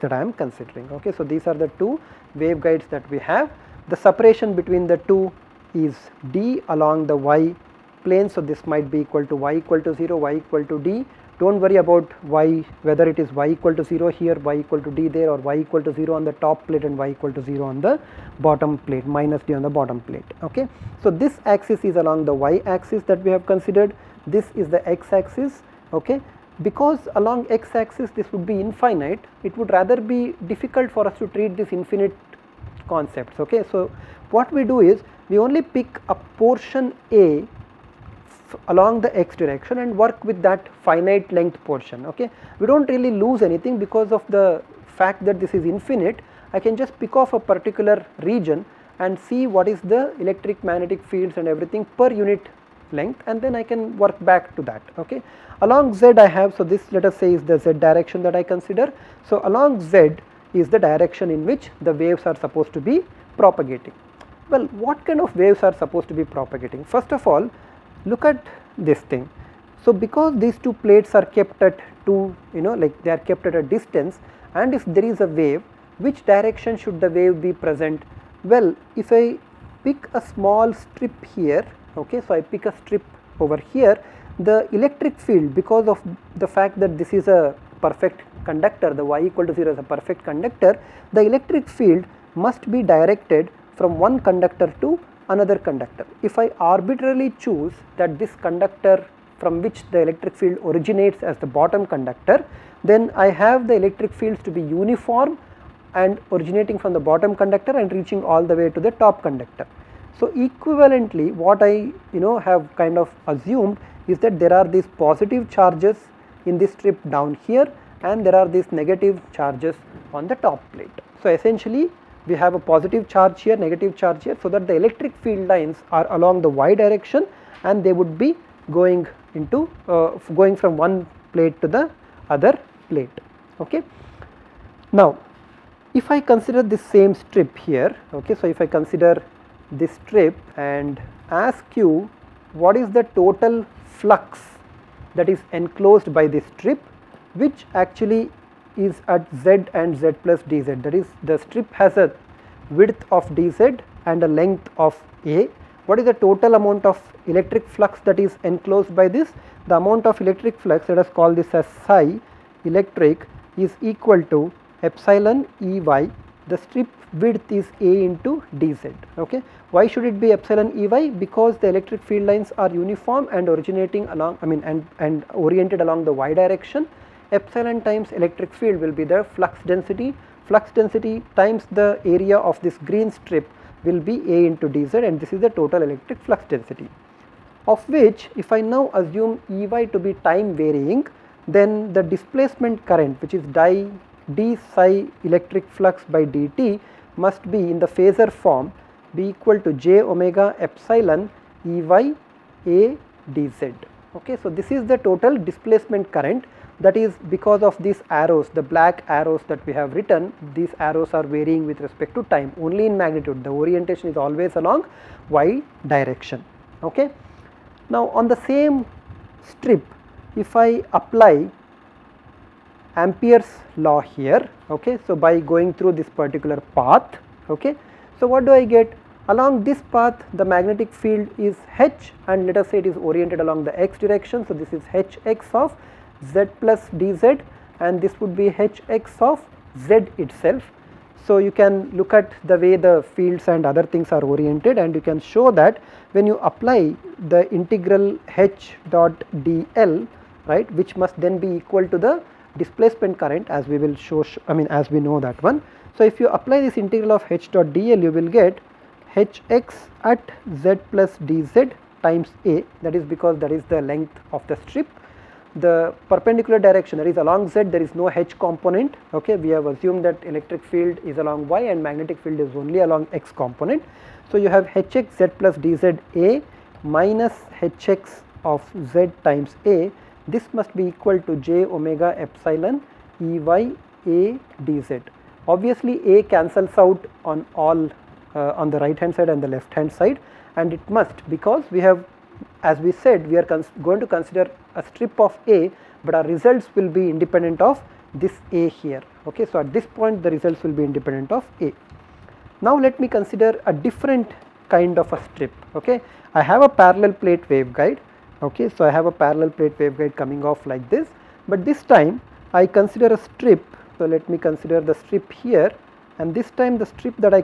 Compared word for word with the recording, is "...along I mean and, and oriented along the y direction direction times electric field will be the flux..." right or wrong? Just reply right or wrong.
wrong.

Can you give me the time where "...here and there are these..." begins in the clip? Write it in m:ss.
1:57.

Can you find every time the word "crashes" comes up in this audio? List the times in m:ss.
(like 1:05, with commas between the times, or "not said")
not said.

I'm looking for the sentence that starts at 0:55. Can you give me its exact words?
Along z I have so this let us say is the z direction that I consider.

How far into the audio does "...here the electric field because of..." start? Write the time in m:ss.
1:23.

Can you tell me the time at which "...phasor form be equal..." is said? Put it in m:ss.
3:17.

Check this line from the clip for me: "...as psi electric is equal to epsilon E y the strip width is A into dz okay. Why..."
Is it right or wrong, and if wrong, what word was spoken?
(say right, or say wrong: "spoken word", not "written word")
right.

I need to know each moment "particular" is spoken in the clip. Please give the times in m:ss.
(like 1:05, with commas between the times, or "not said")
0:47, 3:46.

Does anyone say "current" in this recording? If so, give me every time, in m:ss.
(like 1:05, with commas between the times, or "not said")
3:12, 3:26, 4:13.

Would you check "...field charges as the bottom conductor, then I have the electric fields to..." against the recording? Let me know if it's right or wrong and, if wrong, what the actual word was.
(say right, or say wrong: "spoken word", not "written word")
wrong: "originates", not "charges".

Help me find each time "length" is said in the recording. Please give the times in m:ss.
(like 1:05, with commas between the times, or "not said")
0:41, 0:52, 2:34, 4:23.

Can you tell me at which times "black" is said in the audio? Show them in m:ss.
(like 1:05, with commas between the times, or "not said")
3:28.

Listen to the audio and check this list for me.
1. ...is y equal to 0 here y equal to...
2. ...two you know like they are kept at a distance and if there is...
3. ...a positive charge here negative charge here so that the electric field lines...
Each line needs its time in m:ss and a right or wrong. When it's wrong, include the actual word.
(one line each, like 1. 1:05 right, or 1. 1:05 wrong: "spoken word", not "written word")
1. 0:13 right
2. 1:12 right
3. 2:02 right.